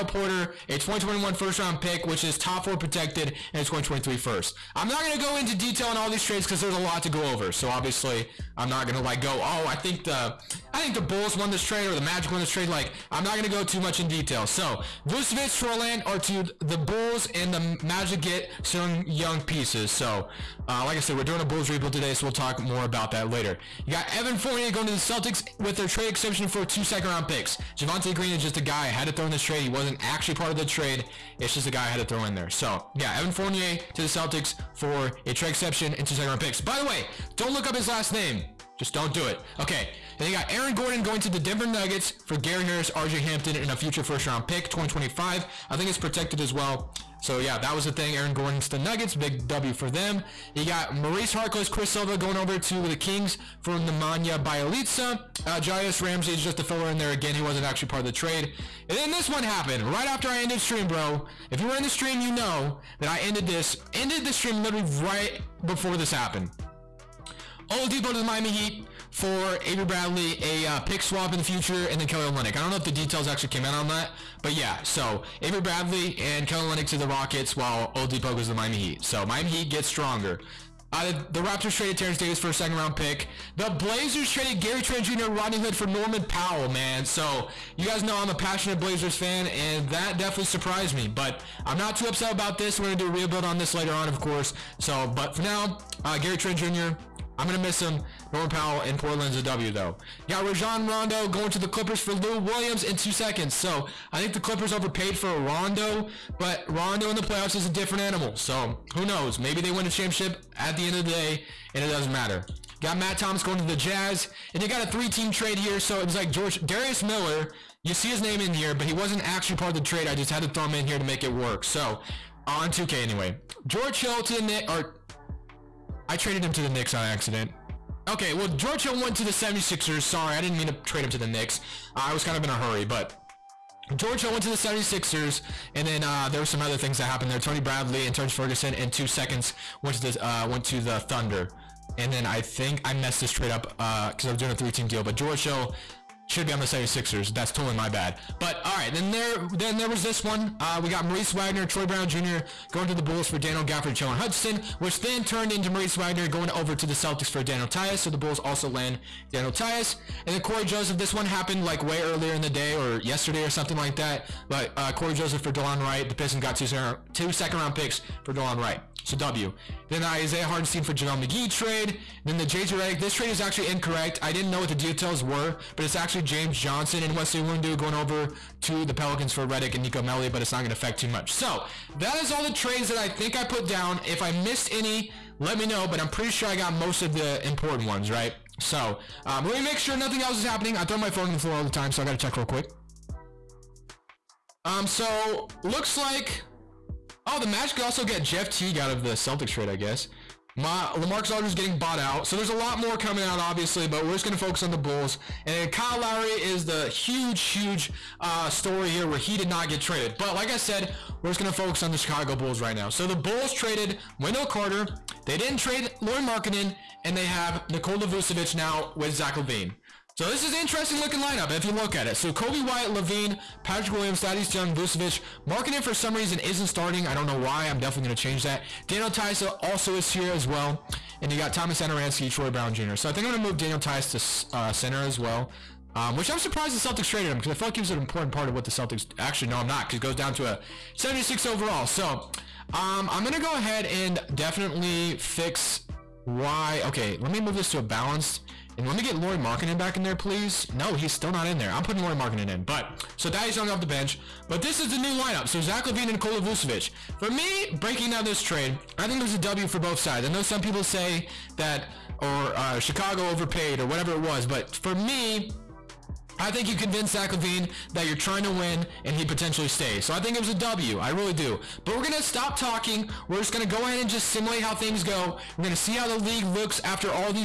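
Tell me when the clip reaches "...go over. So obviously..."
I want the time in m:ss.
0:07.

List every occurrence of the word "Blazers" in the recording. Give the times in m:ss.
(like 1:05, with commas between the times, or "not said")
1:23, 1:28.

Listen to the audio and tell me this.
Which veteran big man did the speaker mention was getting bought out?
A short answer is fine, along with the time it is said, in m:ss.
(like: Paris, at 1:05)
LaMarcus Aldridge, at 3:20.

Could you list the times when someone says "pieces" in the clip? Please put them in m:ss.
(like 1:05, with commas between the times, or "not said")
0:19.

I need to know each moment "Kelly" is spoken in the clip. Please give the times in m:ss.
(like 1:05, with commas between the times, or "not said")
1:12, 1:16.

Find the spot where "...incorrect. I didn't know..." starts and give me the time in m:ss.
2:53.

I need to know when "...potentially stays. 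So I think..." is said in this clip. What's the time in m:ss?
4:29.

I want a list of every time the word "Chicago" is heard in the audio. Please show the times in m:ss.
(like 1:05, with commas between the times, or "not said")
3:31, 4:22.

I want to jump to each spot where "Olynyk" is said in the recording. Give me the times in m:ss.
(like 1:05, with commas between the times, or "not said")
1:12, 1:16.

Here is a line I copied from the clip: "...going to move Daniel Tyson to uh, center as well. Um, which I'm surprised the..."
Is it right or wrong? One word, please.
right.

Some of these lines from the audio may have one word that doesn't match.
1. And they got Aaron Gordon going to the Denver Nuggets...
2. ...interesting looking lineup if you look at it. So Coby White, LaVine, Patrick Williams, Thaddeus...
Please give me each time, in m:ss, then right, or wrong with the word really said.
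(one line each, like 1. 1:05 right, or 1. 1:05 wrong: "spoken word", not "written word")
1. 0:40 right
2. 3:40 right.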